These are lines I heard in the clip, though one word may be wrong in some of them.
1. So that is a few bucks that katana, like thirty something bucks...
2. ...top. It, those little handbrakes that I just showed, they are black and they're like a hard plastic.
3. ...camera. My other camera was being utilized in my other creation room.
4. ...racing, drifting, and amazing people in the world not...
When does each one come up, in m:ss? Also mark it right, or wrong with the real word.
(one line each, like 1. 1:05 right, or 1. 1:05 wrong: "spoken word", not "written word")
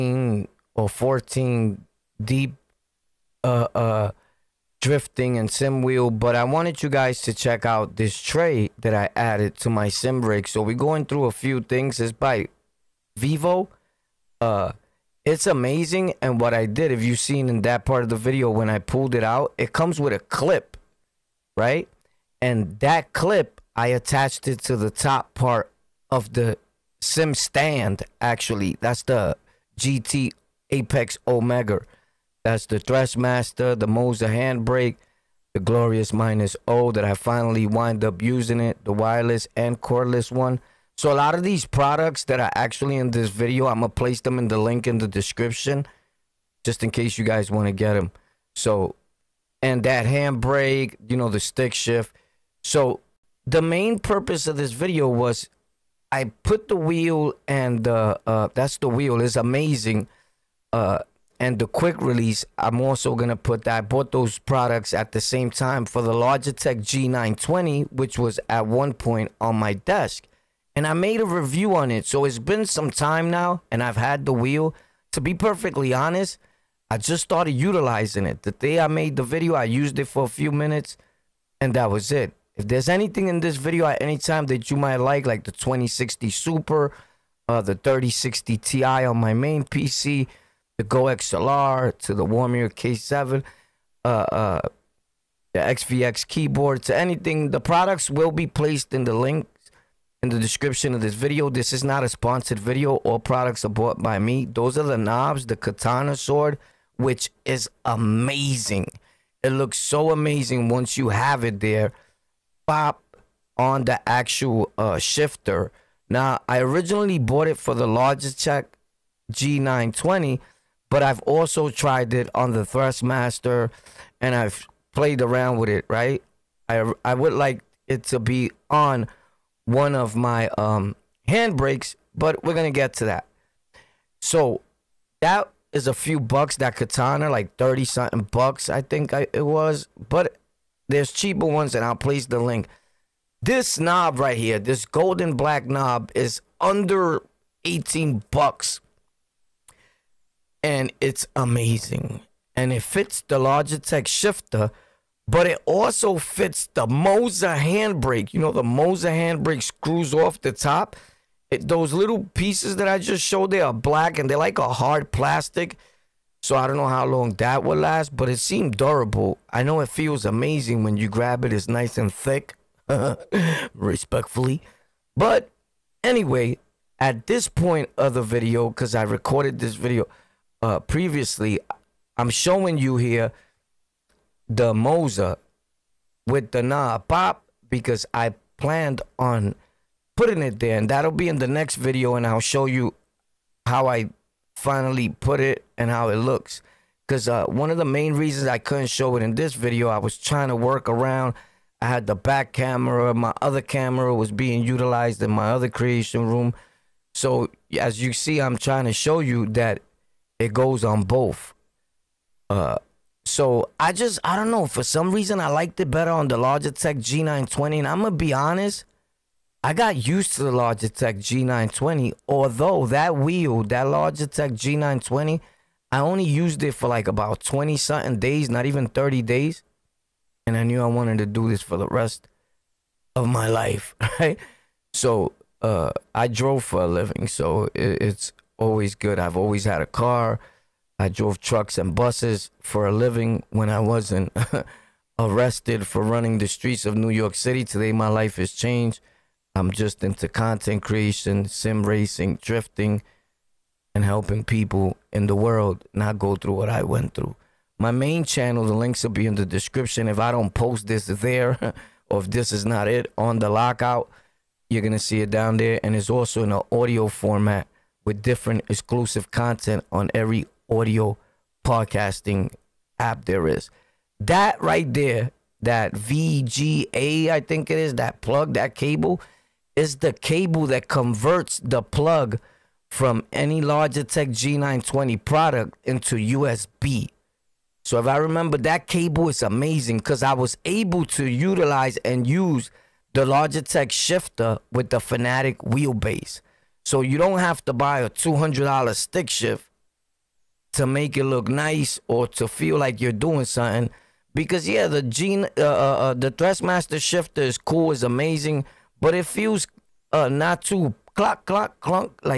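1. 2:14 right
2. 2:40 wrong: "pieces", not "handbrakes"
3. 3:22 right
4. 4:11 wrong: "helping", not "amazing".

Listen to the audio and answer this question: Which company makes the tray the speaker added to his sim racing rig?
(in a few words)
Vivo.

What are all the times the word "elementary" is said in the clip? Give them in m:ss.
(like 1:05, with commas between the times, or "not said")
not said.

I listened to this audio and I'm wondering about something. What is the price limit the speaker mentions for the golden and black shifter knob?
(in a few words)
under 18 dollars.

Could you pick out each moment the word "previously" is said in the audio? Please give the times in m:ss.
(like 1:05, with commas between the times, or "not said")
3:00.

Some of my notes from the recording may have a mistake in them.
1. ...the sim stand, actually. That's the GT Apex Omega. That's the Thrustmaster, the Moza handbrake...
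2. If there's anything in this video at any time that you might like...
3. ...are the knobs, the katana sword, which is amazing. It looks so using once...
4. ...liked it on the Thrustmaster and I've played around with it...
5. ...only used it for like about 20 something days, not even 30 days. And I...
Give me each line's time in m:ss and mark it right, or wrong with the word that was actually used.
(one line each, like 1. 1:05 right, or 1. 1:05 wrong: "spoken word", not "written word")
1. 0:26 right
2. 1:22 right
3. 1:44 wrong: "amazing", not "using"
4. 2:01 wrong: "tried", not "liked"
5. 3:45 right.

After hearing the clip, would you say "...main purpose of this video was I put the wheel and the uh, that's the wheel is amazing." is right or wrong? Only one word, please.
right.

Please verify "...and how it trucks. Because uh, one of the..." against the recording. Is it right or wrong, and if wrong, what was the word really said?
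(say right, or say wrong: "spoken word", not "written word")
wrong: "looks", not "trucks".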